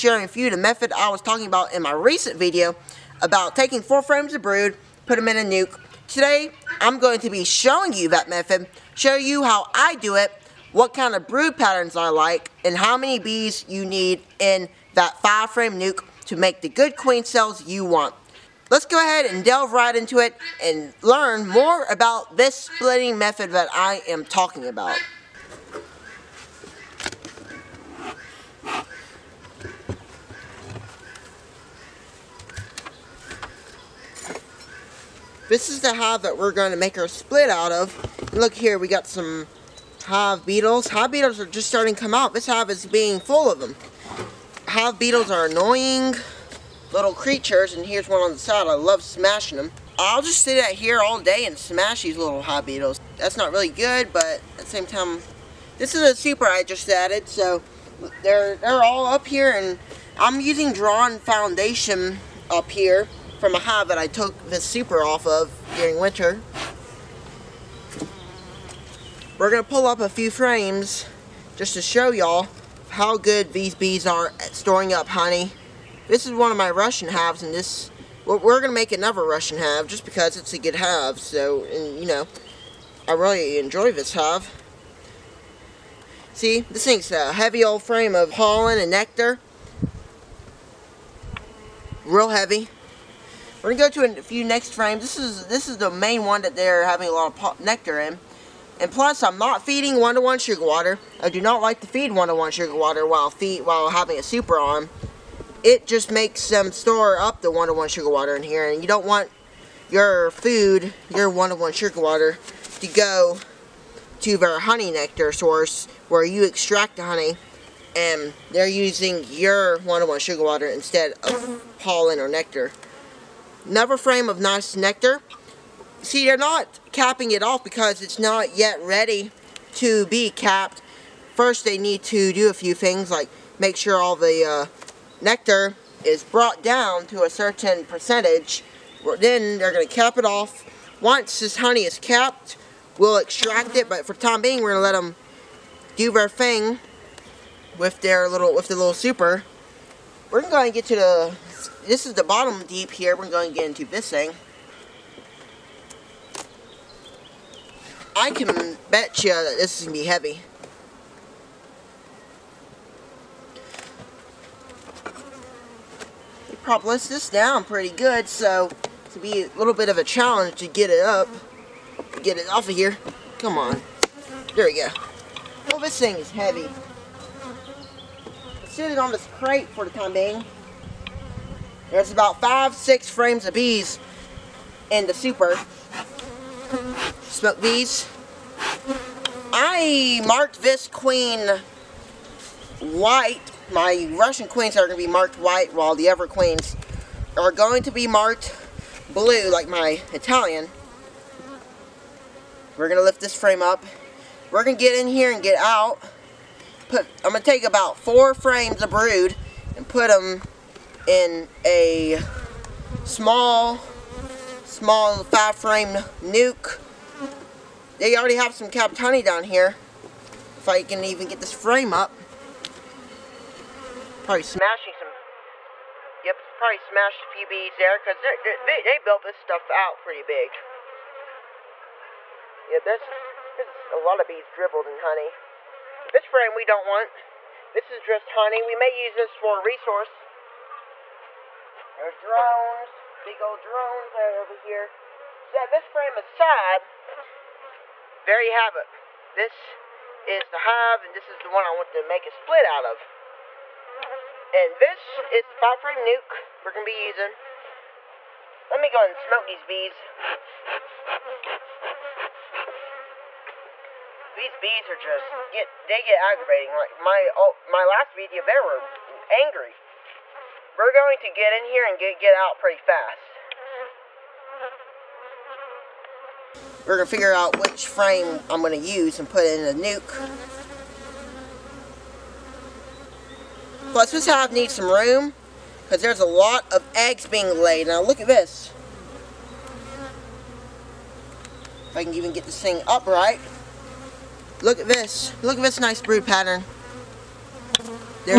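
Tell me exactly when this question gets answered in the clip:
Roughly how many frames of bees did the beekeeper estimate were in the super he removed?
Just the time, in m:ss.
3:02.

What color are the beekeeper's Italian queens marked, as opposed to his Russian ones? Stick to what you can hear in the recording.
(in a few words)
Blue.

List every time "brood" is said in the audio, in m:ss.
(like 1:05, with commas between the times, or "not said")
0:04, 0:11, 3:28, 4:56.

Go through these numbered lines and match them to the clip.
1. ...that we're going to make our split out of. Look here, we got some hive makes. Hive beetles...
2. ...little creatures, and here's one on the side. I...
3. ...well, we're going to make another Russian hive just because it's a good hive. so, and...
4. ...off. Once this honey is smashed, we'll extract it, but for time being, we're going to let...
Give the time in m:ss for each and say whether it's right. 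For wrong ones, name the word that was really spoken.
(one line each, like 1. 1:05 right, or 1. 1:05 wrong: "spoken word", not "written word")
1. 0:36 wrong: "beetles", not "makes"
2. 0:46 right
3. 1:18 right
4. 2:20 wrong: "capped", not "smashed".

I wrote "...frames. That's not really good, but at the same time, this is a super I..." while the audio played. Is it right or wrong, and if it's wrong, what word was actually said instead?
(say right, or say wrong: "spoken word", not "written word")
wrong: "beetles", not "frames".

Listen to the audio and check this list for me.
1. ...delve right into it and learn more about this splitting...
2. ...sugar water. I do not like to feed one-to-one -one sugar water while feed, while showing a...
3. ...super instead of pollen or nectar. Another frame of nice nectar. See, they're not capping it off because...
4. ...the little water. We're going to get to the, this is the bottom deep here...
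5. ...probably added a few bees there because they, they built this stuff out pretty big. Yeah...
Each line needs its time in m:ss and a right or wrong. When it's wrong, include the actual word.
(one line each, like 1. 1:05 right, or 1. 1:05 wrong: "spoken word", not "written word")
1. 0:19 right
2. 1:40 wrong: "having", not "showing"
3. 2:00 wrong: "water", not "super"
4. 2:28 wrong: "super", not "water"
5. 3:46 wrong: "smashed", not "added".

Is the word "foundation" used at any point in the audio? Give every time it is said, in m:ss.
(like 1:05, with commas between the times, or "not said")
1:01.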